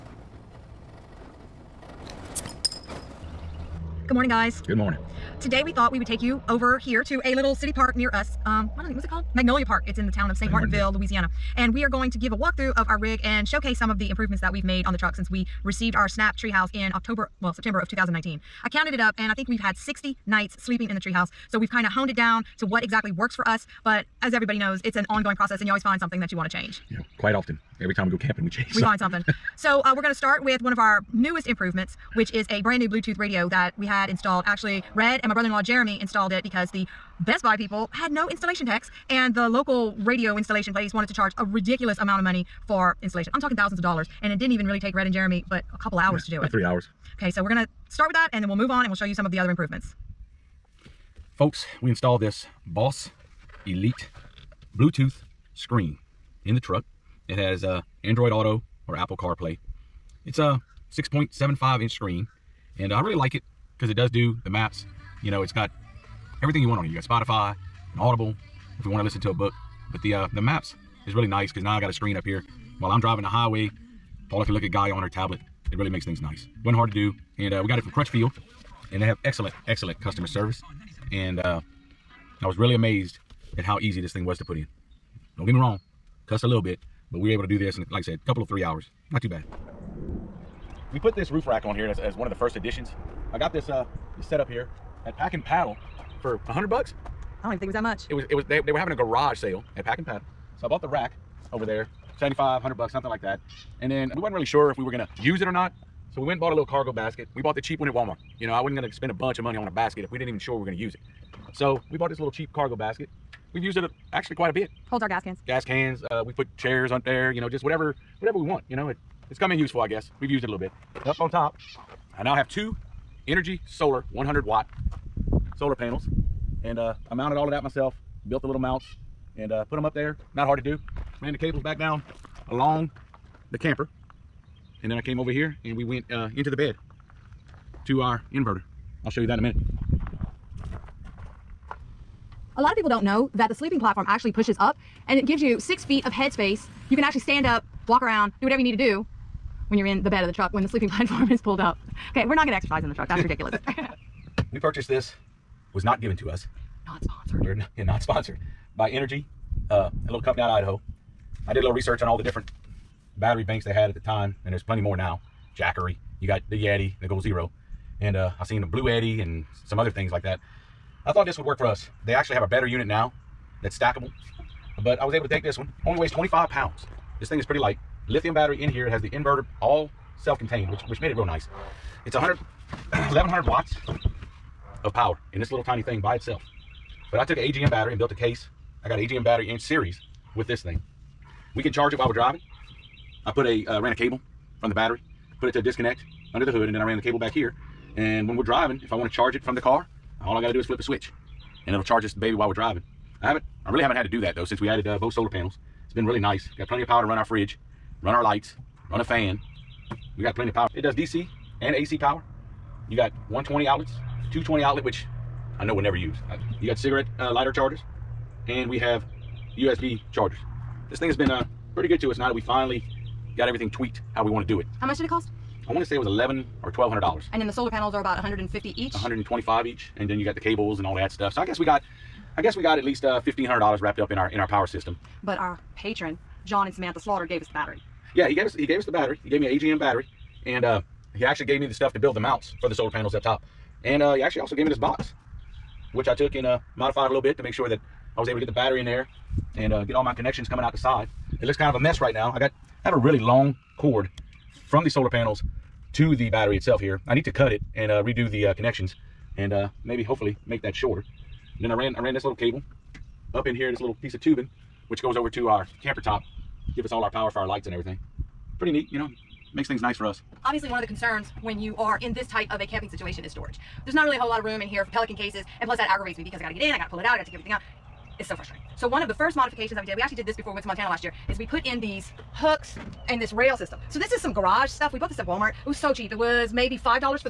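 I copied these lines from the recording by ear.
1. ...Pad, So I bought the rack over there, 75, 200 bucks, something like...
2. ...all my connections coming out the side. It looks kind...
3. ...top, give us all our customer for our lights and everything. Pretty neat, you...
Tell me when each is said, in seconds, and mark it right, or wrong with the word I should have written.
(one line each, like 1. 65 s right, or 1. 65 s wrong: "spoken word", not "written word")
1. 100 s wrong: "100", not "200"
2. 249 s right
3. 265 s wrong: "power", not "customer".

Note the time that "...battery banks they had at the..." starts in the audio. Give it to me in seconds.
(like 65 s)
163 s.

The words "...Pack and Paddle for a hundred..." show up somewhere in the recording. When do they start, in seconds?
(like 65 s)
95 s.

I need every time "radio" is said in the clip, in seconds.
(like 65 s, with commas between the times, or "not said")
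33 s, 39 s.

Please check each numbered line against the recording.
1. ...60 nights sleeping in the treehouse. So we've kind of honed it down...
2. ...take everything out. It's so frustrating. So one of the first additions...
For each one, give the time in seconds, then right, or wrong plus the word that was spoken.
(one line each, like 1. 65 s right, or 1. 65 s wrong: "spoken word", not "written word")
1. 19 s right
2. 277 s wrong: "modifications", not "additions".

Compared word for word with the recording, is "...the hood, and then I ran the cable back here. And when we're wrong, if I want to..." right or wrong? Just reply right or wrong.
wrong.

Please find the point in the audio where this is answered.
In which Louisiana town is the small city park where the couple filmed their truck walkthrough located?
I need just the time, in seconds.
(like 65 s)
10 s.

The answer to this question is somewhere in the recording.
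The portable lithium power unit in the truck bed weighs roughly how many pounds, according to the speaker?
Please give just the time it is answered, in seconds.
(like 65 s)
176 s.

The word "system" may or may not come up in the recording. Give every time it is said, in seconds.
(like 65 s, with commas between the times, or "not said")
234 s, 283 s.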